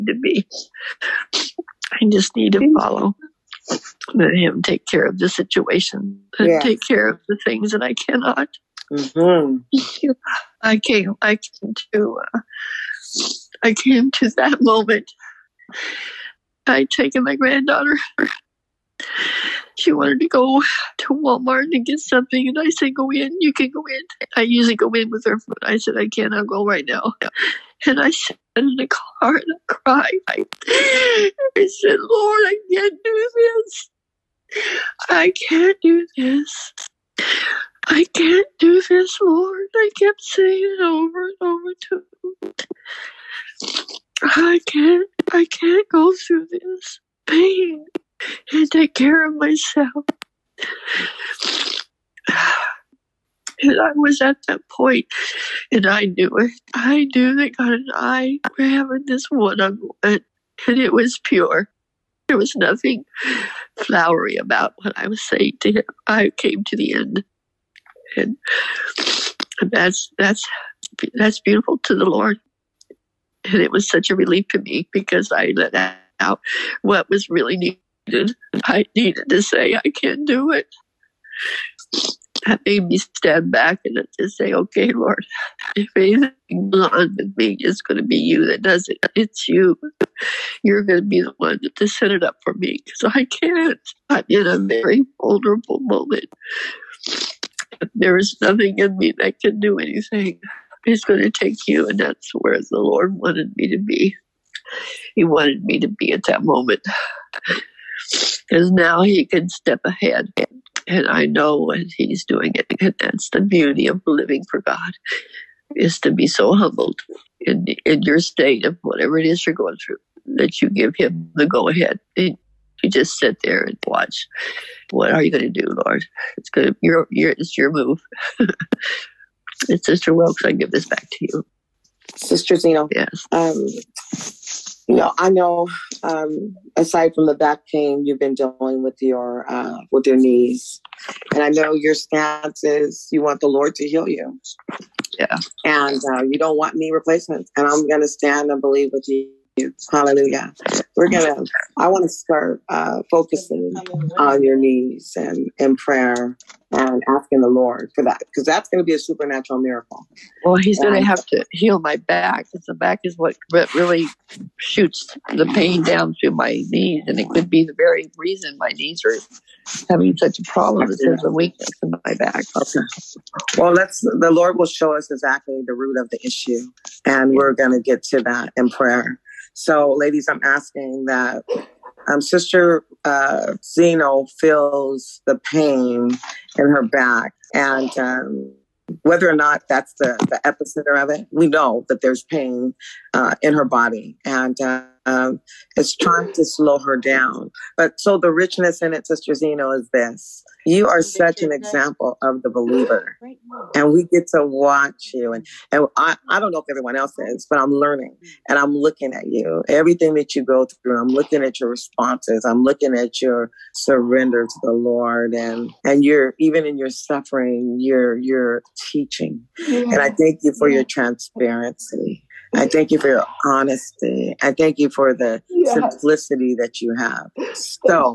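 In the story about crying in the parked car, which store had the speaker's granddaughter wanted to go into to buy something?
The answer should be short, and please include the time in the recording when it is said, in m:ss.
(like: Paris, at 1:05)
Walmart, at 0:21.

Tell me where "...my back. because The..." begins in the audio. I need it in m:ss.
2:41.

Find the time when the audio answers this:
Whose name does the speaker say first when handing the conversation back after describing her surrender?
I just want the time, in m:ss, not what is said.
2:09.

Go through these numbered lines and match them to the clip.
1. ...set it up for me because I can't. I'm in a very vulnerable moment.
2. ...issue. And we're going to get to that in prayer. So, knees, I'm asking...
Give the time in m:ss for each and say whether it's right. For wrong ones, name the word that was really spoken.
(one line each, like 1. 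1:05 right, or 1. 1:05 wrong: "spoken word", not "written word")
1. 1:31 right
2. 2:56 wrong: "ladies", not "knees".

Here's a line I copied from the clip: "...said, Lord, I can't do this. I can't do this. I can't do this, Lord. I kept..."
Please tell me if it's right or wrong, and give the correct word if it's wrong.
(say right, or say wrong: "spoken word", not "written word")
right.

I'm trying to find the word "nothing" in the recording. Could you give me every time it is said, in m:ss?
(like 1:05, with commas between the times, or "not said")
1:02, 1:38.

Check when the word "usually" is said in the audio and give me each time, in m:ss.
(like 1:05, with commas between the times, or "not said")
0:24.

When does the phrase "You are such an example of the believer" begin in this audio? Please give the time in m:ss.
3:20.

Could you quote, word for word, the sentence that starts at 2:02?
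And you just sit there and watch.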